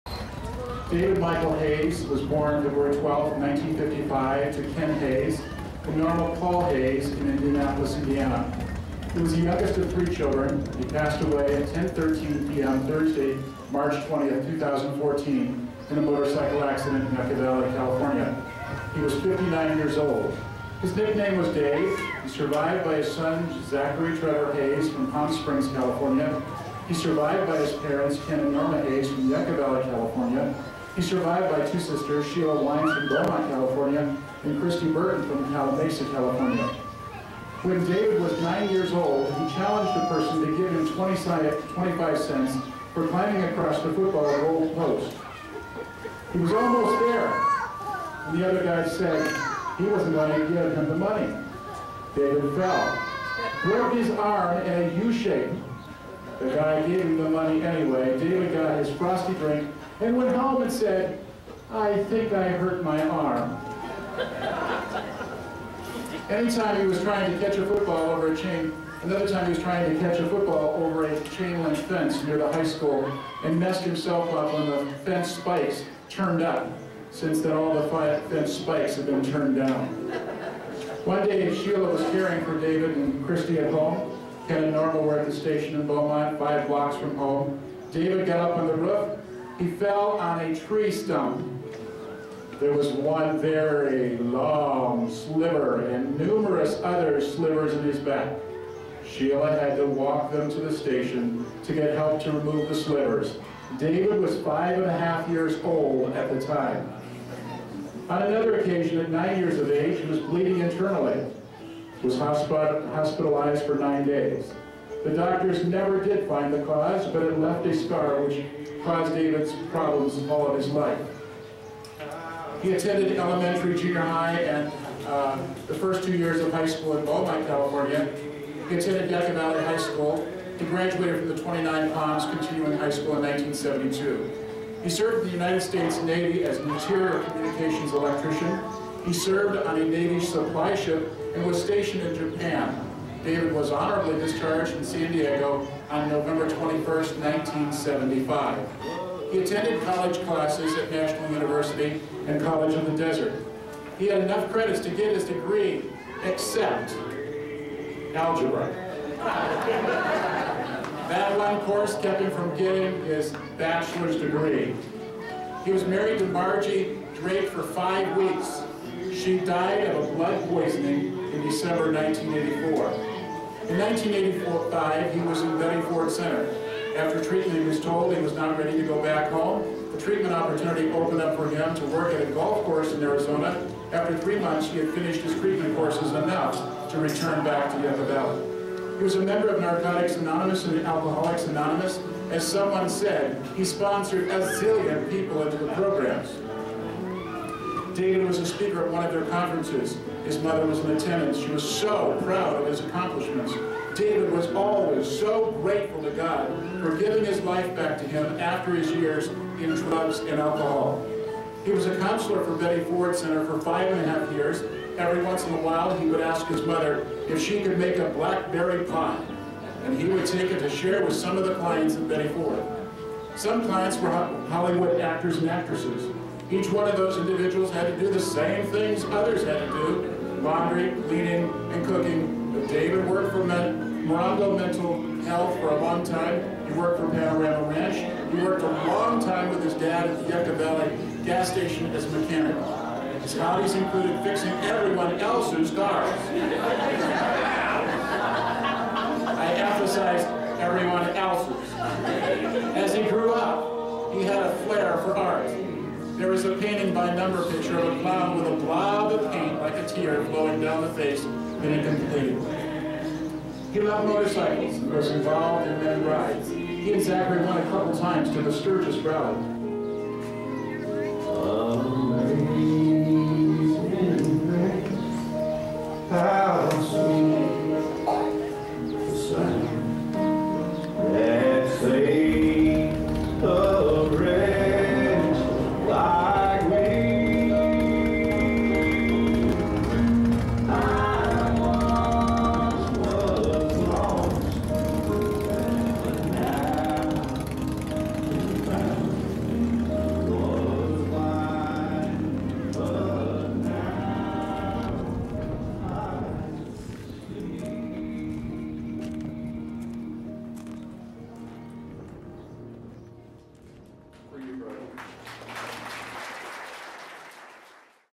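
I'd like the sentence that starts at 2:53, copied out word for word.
In 1984-5, he was in Betty Ford Center.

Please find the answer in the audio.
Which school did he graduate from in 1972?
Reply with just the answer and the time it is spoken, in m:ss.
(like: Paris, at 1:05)
29 Palms Continuing High School, at 2:11.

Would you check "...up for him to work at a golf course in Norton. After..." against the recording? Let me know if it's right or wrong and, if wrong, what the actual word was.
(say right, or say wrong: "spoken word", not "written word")
wrong: "Arizona", not "Norton".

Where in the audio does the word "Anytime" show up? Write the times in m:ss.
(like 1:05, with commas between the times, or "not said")
1:06.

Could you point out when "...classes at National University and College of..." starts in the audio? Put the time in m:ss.
2:30.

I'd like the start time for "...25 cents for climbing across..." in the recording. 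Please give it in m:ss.
0:41.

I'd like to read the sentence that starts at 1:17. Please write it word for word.
Since then, all the fence spikes have been turned down.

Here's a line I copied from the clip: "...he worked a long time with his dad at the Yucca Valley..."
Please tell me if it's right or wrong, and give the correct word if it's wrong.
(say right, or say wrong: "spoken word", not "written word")
right.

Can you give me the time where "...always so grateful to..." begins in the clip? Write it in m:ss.
3:24.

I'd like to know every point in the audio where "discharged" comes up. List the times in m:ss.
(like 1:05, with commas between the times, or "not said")
2:24.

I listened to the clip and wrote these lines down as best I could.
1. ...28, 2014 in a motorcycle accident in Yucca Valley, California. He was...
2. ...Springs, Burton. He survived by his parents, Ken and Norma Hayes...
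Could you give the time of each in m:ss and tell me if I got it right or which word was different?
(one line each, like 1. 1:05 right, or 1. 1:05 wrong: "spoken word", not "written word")
1. 0:14 wrong: "20", not "28"
2. 0:25 wrong: "California", not "Burton".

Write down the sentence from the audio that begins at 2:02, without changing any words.
He attended elementary, junior high, and uh, the first two years of high school in Beaumont, California.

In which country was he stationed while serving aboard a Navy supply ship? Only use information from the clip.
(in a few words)
Japan.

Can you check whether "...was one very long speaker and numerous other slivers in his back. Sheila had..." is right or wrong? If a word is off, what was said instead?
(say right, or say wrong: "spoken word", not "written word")
wrong: "sliver", not "speaker".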